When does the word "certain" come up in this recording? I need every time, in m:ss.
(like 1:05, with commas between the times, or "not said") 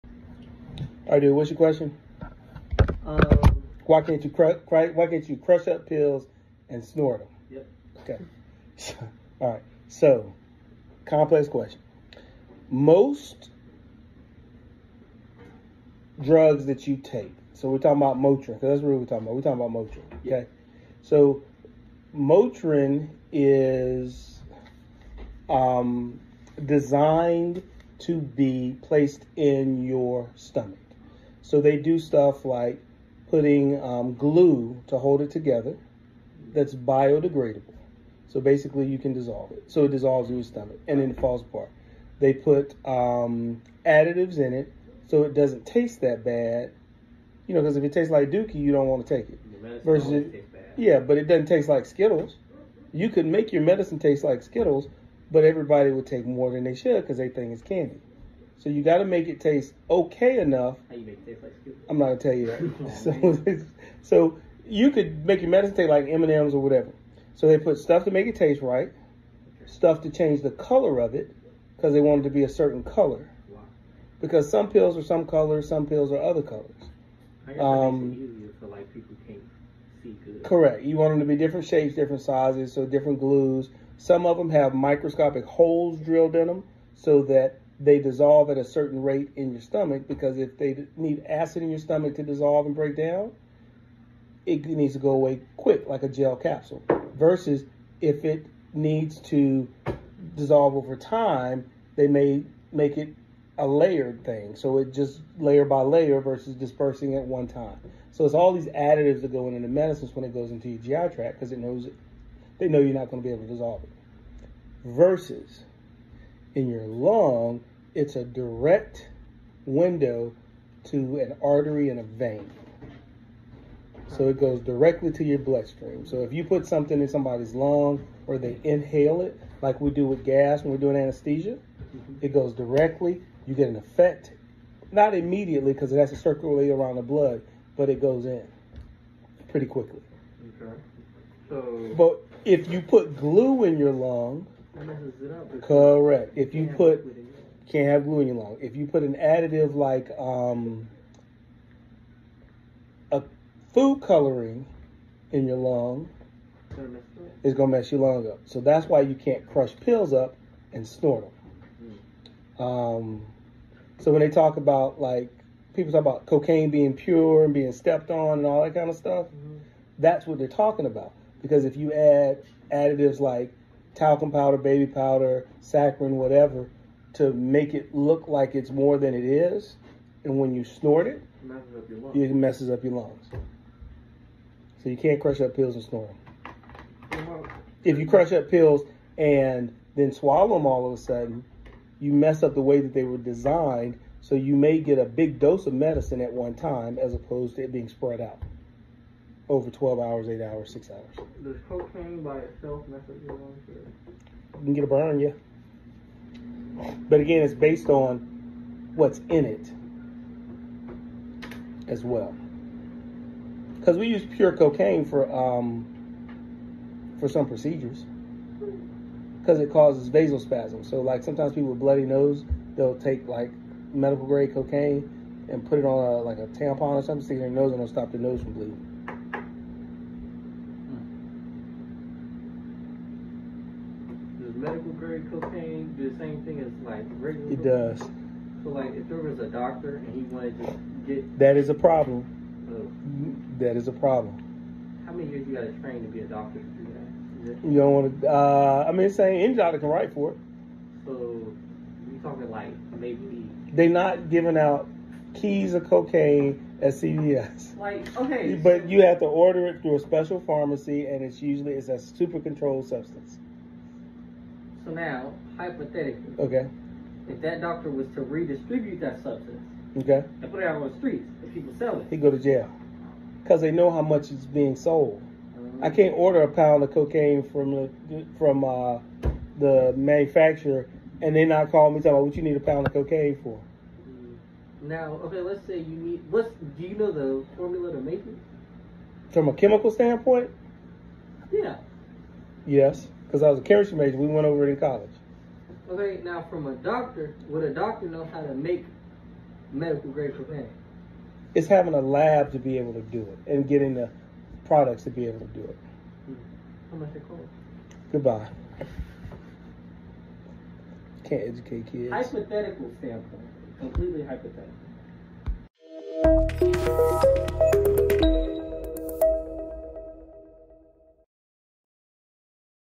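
1:12, 1:28.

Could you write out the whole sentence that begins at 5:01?
It's having a lab to be able to do it and getting the products to be able to do it.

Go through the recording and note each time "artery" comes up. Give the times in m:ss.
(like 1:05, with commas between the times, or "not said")
2:01.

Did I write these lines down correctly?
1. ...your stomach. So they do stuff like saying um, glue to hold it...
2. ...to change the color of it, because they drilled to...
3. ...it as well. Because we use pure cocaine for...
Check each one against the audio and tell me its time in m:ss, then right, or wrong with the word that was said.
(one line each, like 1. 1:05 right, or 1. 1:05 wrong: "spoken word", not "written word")
1. 0:29 wrong: "putting", not "saying"
2. 1:10 wrong: "wanted", not "drilled"
3. 3:29 right.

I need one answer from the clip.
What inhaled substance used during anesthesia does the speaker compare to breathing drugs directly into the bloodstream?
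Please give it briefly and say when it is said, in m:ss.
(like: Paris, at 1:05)
gas, at 2:10.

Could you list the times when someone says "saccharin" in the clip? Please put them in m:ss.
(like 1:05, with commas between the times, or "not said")
2:55.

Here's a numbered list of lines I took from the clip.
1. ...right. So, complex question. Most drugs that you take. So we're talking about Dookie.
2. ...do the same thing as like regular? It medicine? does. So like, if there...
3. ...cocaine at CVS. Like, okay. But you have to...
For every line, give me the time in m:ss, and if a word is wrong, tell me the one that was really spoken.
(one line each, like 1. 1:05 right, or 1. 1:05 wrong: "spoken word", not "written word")
1. 0:09 wrong: "Motrin", not "Dookie"
2. 3:55 wrong: "cocaine", not "medicine"
3. 4:15 right.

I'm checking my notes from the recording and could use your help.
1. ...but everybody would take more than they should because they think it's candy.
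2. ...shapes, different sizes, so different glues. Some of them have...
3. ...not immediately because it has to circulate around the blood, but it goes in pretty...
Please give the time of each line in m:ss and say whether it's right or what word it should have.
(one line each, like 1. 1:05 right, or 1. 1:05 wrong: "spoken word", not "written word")
1. 0:55 right
2. 1:21 right
3. 2:14 right.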